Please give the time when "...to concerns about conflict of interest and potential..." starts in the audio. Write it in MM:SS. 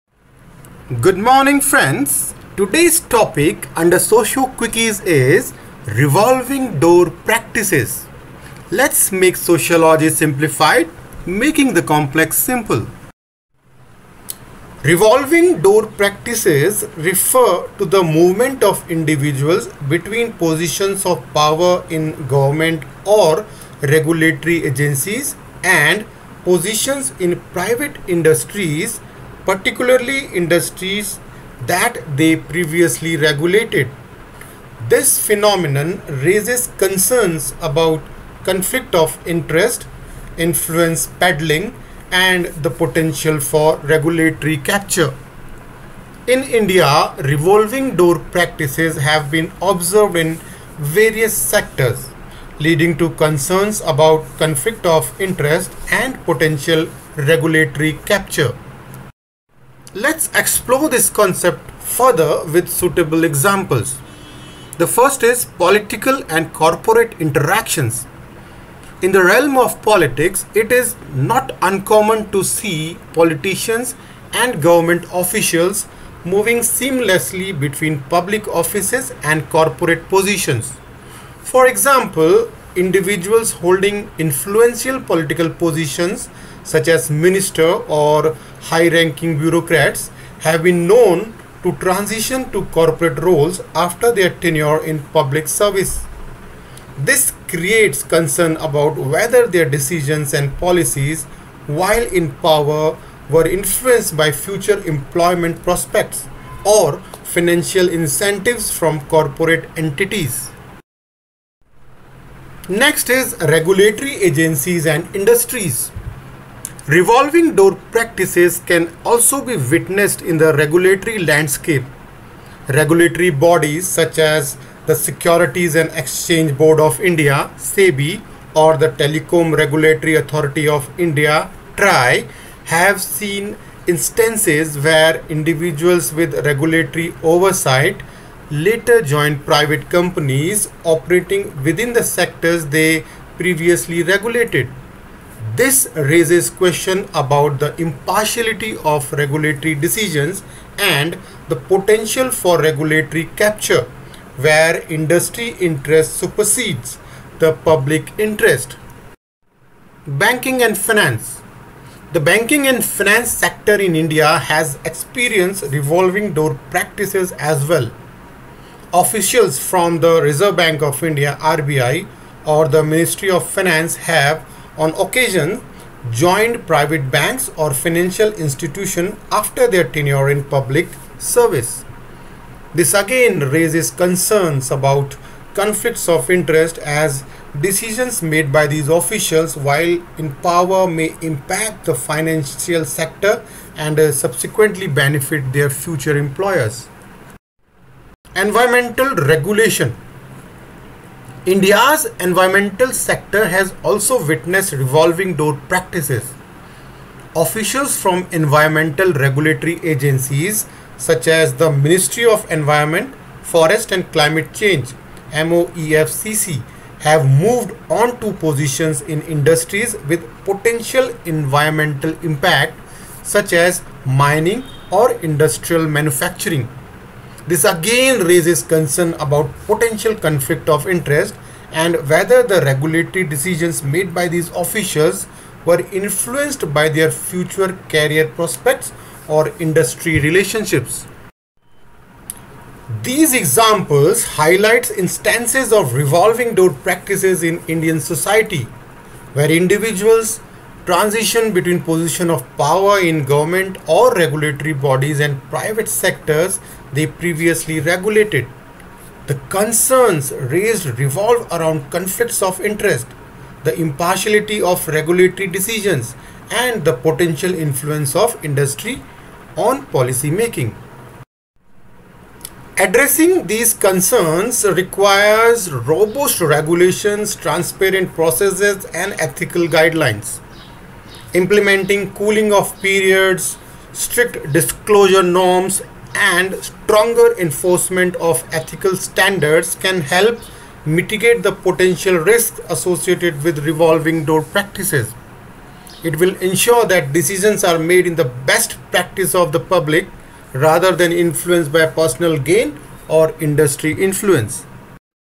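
00:52.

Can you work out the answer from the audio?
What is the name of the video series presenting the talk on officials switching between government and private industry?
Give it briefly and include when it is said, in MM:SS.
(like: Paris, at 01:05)
Socio Quickies, at 00:03.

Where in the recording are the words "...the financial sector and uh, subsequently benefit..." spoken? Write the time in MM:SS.
03:11.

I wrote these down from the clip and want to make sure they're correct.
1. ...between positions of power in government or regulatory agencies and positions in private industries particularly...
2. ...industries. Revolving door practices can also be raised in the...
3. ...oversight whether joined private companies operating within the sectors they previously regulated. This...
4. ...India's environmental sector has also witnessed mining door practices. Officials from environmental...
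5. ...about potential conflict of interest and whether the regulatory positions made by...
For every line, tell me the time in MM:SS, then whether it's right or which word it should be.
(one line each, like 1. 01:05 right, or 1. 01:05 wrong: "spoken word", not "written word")
1. 00:19 right
2. 01:55 wrong: "witnessed", not "raised"
3. 02:17 wrong: "later", not "whether"
4. 03:21 wrong: "revolving", not "mining"
5. 03:49 wrong: "decisions", not "positions".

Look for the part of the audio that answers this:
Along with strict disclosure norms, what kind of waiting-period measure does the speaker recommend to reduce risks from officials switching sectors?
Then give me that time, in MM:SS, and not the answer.
04:42.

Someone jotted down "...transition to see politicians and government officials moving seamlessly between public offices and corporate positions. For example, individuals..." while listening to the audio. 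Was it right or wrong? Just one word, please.
wrong.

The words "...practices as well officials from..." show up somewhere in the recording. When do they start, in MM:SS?
02:46.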